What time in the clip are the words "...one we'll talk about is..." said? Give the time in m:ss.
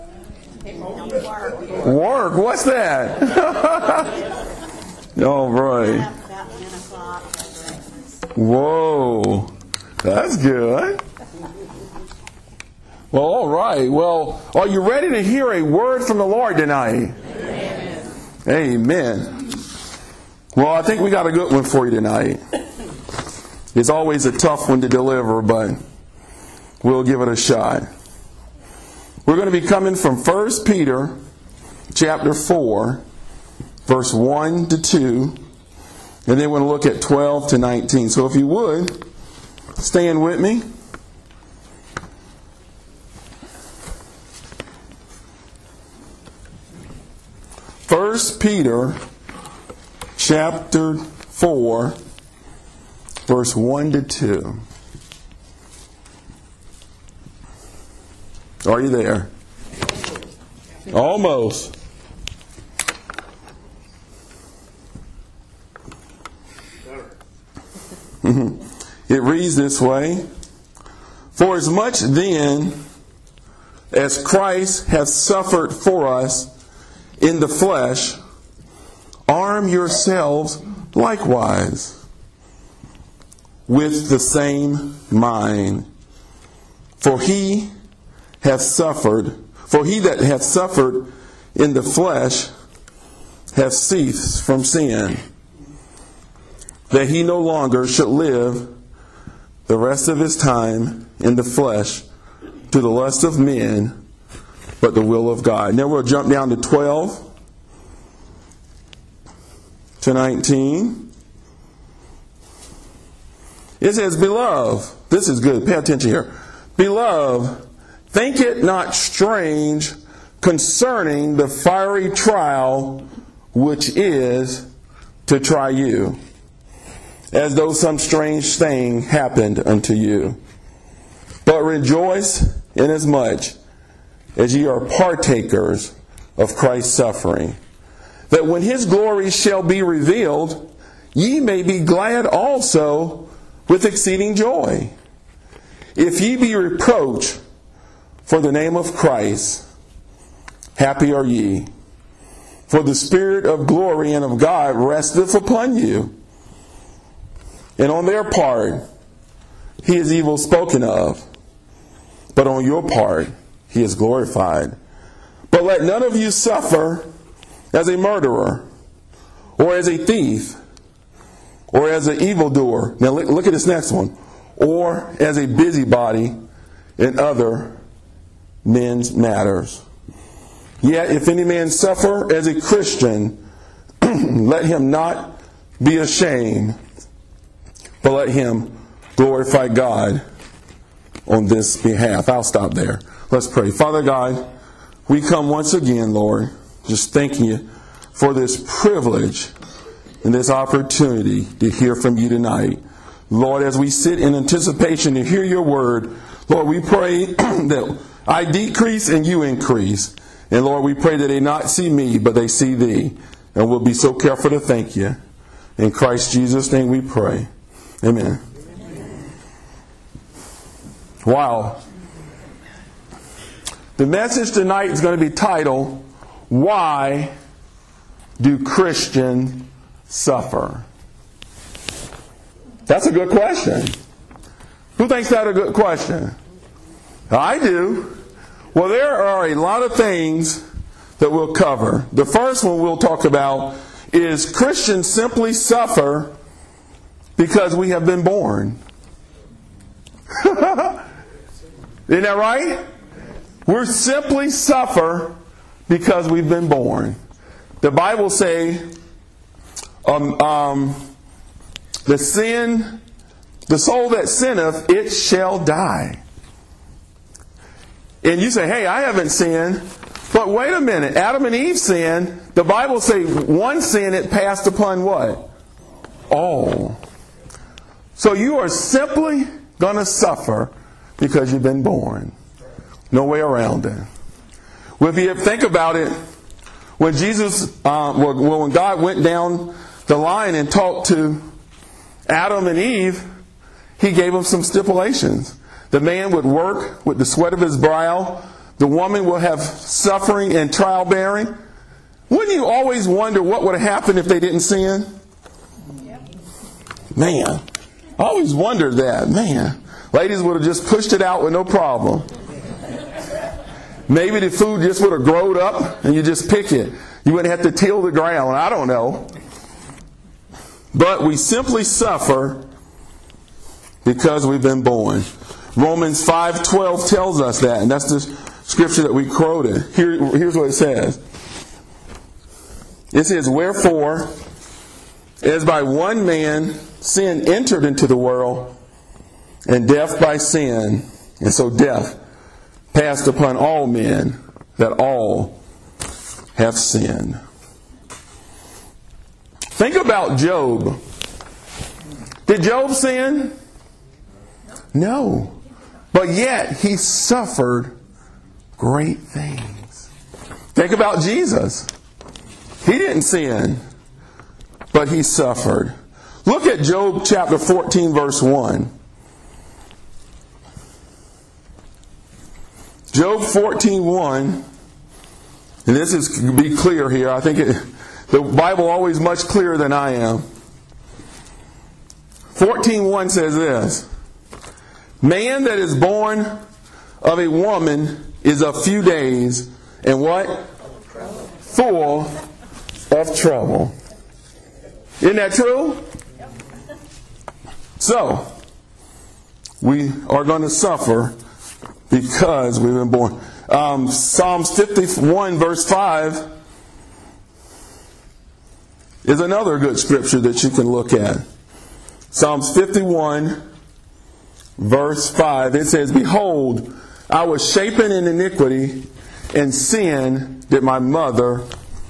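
4:02.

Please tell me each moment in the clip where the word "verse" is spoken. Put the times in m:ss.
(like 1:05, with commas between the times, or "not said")
0:33, 0:53, 6:08, 6:45, 6:54.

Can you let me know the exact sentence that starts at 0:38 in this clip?
So if you would, stand with me.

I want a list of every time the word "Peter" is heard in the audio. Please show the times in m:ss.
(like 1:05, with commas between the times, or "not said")
0:30, 0:48.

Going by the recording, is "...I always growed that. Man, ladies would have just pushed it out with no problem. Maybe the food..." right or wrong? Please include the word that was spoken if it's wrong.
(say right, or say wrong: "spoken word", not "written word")
wrong: "wondered", not "growed".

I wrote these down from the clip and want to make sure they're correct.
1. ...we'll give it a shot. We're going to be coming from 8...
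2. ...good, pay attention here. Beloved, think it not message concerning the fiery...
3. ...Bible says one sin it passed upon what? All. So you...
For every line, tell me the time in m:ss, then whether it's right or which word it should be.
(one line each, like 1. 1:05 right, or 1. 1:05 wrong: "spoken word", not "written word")
1. 0:26 wrong: "1", not "8"
2. 1:55 wrong: "strange", not "message"
3. 4:32 right.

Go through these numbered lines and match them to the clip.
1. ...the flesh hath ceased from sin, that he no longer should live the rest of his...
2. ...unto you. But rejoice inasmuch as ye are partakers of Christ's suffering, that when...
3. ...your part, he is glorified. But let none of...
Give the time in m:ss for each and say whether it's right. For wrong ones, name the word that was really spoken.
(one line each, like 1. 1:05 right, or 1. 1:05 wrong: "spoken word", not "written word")
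1. 1:31 right
2. 2:09 right
3. 2:42 right.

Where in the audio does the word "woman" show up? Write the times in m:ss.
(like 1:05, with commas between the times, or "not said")
4:58, 6:27.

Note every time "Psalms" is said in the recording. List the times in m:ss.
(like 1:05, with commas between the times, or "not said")
6:44, 6:52.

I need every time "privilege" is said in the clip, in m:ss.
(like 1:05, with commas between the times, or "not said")
3:18.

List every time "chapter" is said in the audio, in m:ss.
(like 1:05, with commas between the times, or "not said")
0:31, 0:50, 6:07.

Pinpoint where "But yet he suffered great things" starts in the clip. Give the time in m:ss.
5:56.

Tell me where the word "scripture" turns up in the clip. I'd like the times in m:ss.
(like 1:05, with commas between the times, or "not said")
5:28, 6:49.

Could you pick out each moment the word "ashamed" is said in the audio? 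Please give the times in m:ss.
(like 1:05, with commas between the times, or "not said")
3:05.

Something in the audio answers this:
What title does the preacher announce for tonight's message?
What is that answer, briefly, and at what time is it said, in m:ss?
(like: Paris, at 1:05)
Why Do Christians Suffer?, at 3:46.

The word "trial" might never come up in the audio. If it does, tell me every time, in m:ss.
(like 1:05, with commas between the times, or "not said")
2:02, 5:00.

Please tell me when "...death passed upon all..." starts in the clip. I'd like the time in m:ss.
5:41.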